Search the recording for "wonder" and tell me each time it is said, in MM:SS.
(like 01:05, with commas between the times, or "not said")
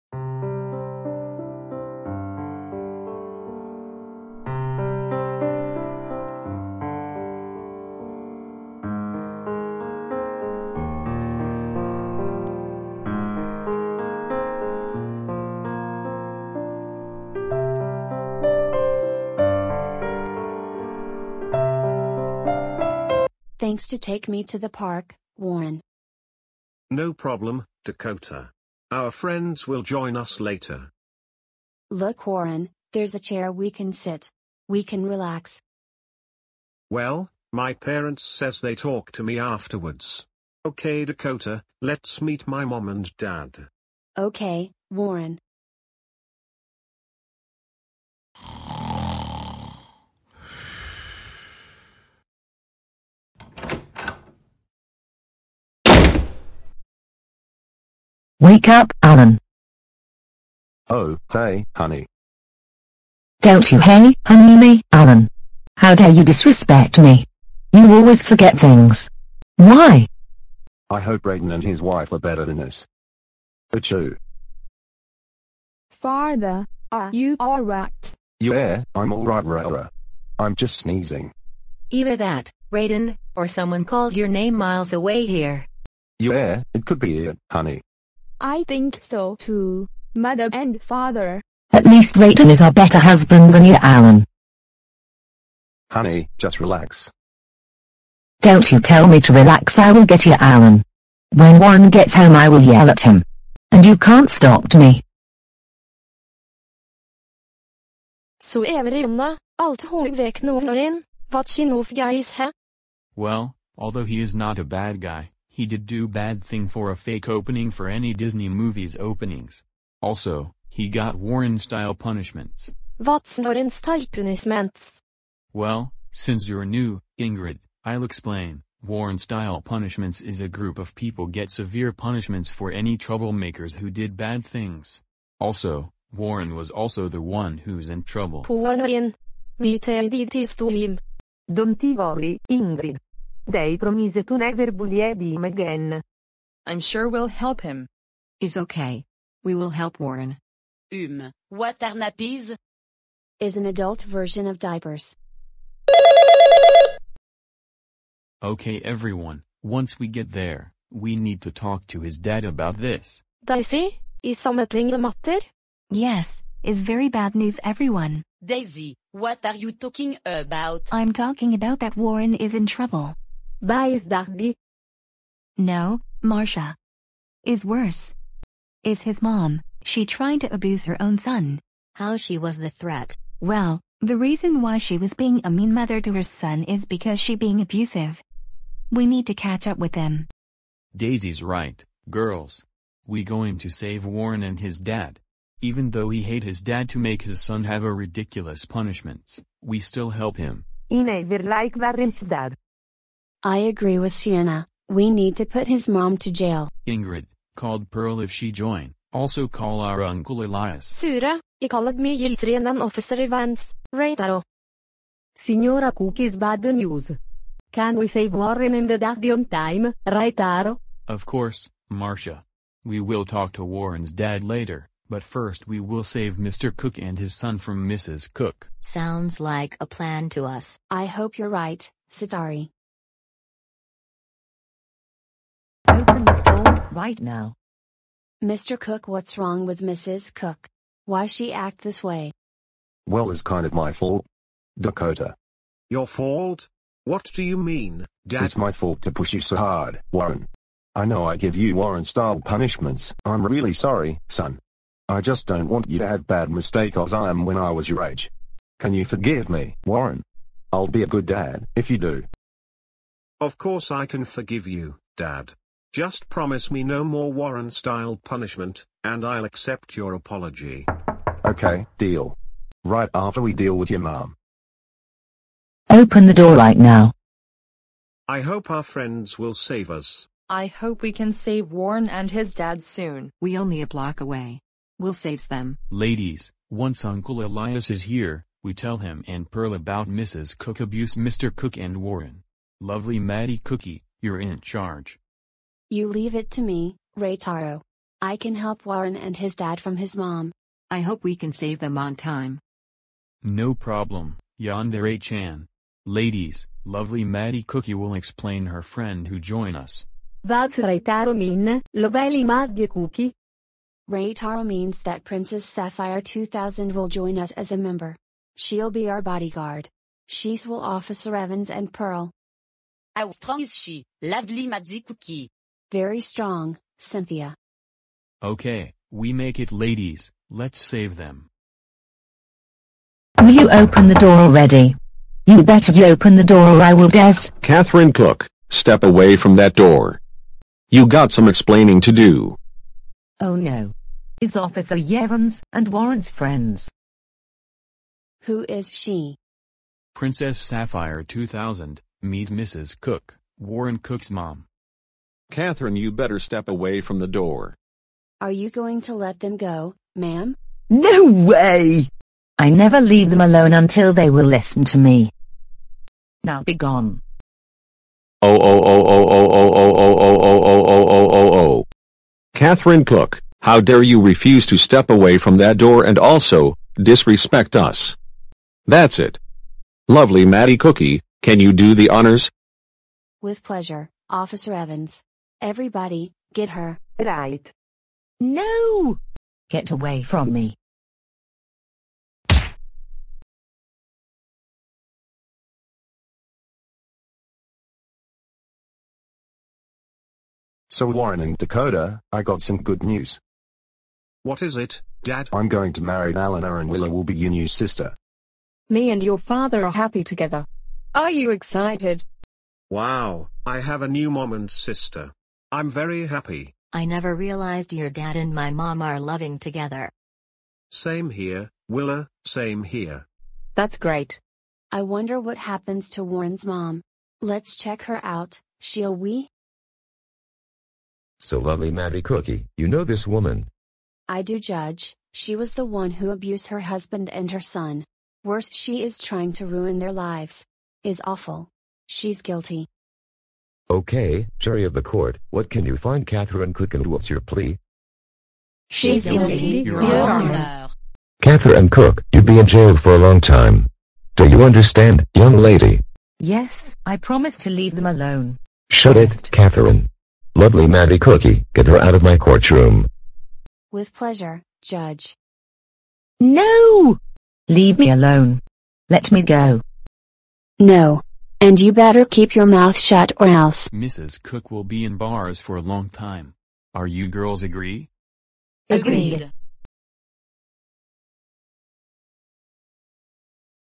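07:05.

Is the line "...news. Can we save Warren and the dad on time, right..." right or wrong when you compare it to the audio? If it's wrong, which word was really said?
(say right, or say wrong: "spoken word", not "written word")
right.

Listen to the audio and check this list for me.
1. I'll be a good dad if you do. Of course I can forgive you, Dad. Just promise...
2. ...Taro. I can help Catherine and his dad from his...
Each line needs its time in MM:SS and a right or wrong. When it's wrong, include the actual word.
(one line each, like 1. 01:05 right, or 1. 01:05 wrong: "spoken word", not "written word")
1. 04:20 right
2. 04:57 wrong: "Warren", not "Catherine".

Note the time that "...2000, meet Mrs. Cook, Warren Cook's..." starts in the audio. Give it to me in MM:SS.
05:51.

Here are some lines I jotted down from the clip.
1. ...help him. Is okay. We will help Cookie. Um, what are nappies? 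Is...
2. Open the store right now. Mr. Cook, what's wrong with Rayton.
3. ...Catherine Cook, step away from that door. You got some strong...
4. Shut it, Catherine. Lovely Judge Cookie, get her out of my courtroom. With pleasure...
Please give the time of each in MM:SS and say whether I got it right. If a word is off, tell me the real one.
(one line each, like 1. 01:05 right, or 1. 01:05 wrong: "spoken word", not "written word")
1. 02:27 wrong: "Warren", not "Cookie"
2. 03:55 wrong: "Mrs", not "Rayton"
3. 05:37 wrong: "explaining", not "strong"
4. 07:38 wrong: "Maddie", not "Judge".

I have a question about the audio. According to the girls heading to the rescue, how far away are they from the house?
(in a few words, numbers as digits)
a block.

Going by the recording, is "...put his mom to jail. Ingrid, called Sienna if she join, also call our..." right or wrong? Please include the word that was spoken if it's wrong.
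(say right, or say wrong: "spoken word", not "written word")
wrong: "Pearl", not "Sienna".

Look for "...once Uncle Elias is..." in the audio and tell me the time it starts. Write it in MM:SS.
04:46.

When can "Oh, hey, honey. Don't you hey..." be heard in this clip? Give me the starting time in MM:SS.
01:00.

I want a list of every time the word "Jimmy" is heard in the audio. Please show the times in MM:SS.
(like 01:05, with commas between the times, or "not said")
not said.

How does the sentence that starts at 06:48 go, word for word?
Me and your father are happy together.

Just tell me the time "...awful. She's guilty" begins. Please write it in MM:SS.
07:21.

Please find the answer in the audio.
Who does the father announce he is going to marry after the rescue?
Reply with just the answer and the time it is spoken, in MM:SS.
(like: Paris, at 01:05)
Alana, at 06:45.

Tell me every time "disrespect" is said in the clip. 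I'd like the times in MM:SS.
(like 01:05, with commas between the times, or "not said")
01:06, 06:16.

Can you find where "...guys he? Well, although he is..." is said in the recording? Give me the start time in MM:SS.
01:51.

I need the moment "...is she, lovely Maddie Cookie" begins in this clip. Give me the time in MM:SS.
05:23.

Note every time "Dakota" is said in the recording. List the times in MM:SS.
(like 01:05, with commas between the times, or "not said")
00:27, 00:41, 04:04, 06:41.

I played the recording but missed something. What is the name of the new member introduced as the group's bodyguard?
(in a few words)
Princess Sapphire 2000.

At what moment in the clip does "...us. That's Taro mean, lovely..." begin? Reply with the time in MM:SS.
05:09.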